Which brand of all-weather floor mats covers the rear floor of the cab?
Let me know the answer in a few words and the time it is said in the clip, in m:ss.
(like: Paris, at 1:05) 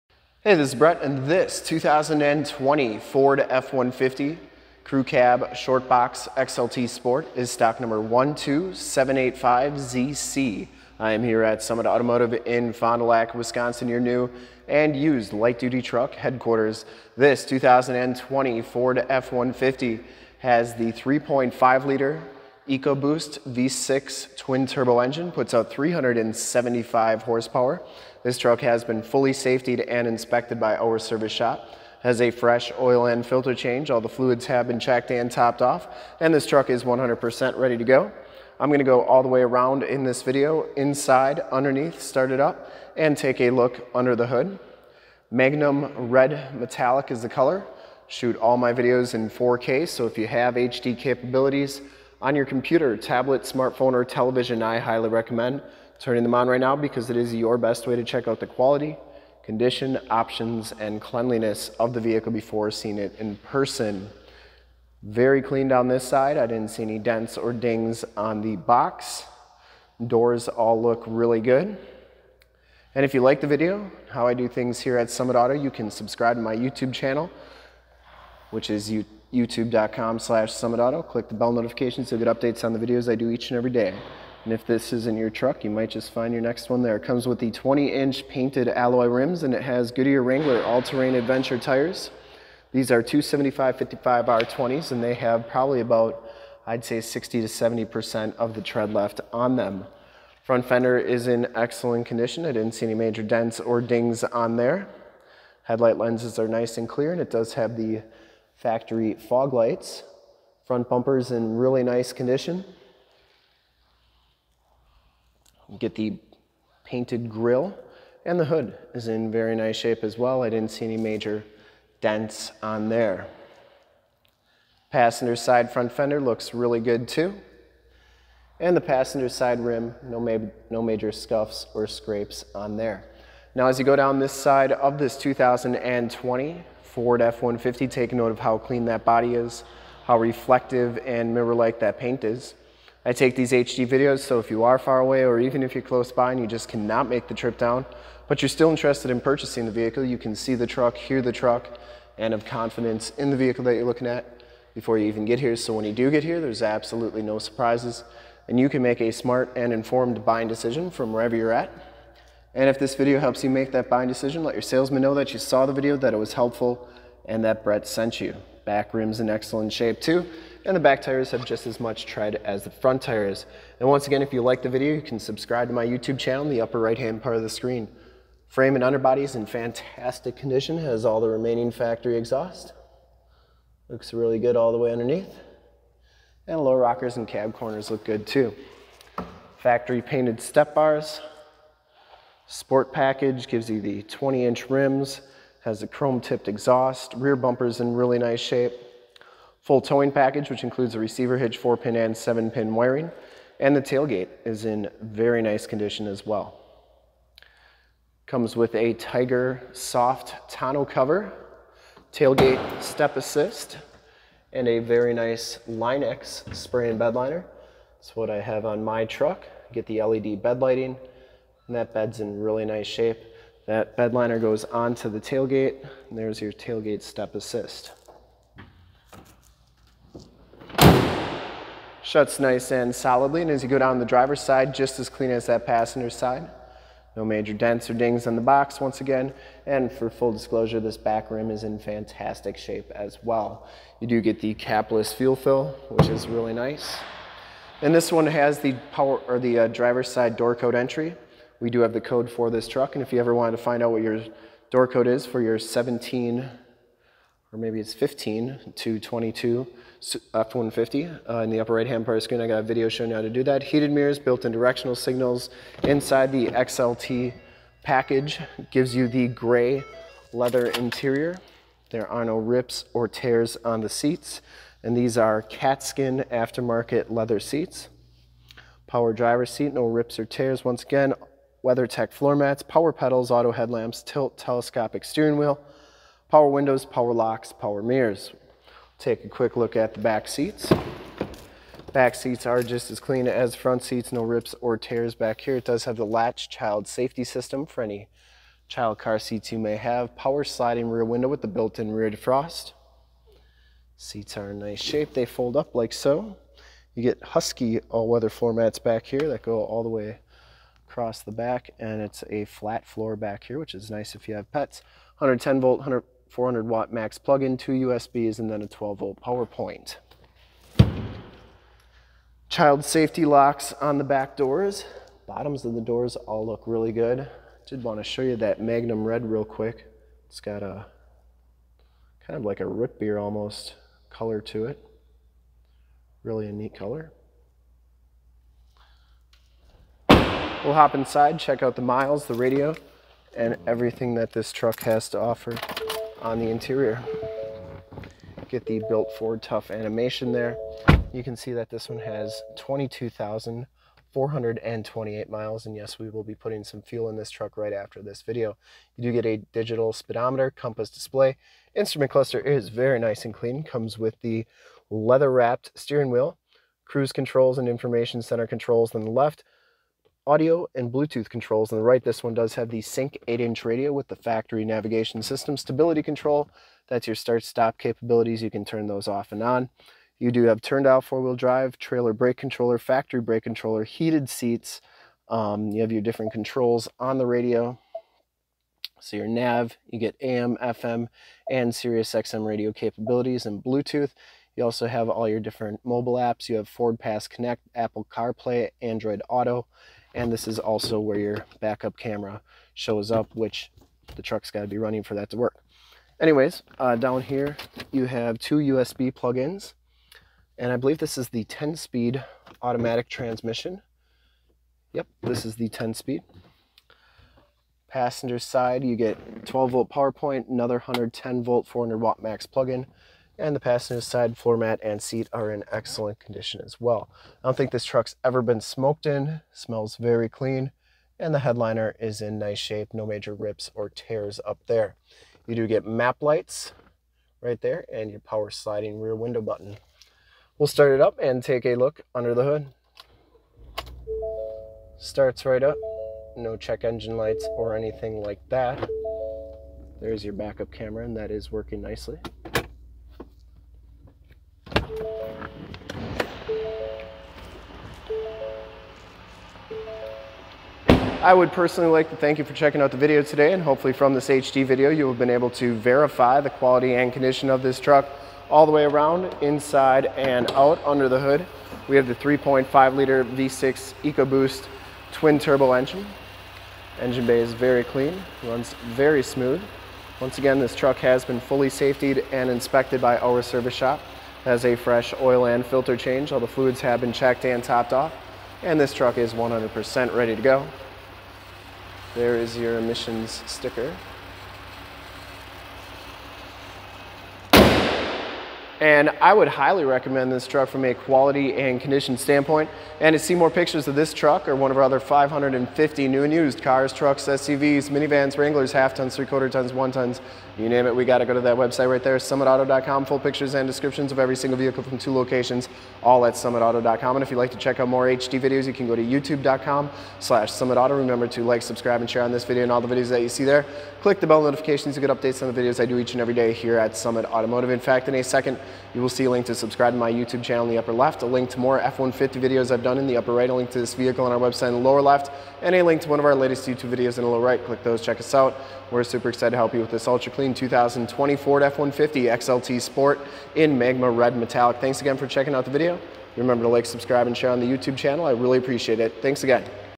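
Husky, at 5:07.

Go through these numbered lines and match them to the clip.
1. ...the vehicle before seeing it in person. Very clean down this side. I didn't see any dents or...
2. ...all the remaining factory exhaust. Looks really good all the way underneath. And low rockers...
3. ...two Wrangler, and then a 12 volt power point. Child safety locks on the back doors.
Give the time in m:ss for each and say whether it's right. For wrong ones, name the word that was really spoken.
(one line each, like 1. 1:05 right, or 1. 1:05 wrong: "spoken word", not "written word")
1. 1:01 right
2. 3:01 right
3. 5:17 wrong: "USBs", not "Wrangler".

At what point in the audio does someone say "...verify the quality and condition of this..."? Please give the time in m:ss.
7:45.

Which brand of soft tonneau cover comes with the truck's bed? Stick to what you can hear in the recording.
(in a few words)
Tiger.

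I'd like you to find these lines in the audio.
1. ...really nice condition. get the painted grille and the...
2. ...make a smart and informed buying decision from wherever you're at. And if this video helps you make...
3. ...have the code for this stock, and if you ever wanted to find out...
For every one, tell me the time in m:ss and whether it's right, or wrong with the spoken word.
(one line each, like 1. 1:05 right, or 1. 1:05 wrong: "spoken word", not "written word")
1. 1:51 right
2. 2:38 right
3. 4:11 wrong: "truck", not "stock".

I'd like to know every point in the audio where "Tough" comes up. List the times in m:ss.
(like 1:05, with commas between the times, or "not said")
5:49.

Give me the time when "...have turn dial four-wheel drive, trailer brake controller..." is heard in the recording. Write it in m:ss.
6:20.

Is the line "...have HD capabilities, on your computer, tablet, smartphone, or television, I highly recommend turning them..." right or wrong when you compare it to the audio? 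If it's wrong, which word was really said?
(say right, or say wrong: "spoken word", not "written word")
right.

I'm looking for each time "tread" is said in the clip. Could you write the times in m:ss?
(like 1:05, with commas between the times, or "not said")
1:38, 2:52.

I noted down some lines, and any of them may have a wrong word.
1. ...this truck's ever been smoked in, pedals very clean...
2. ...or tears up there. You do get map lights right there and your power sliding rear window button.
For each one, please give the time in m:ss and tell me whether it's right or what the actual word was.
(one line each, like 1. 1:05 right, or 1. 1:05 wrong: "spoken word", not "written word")
1. 7:07 wrong: "smells", not "pedals"
2. 7:13 right.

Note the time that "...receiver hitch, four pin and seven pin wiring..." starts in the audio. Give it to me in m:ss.
3:20.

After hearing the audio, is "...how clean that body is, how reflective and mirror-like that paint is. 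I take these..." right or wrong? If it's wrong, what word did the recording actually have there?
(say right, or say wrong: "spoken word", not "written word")
right.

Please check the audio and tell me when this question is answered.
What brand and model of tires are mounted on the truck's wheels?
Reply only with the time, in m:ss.
1:29.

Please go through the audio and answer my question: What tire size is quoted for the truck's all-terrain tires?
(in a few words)
275 55R20.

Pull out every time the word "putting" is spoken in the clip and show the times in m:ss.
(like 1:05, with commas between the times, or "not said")
5:56.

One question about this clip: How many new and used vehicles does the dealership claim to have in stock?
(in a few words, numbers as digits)
550.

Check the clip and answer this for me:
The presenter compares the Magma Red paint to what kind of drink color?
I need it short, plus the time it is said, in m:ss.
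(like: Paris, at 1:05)
root beer, at 5:32.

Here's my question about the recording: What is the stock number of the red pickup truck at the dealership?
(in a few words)
12785ZC.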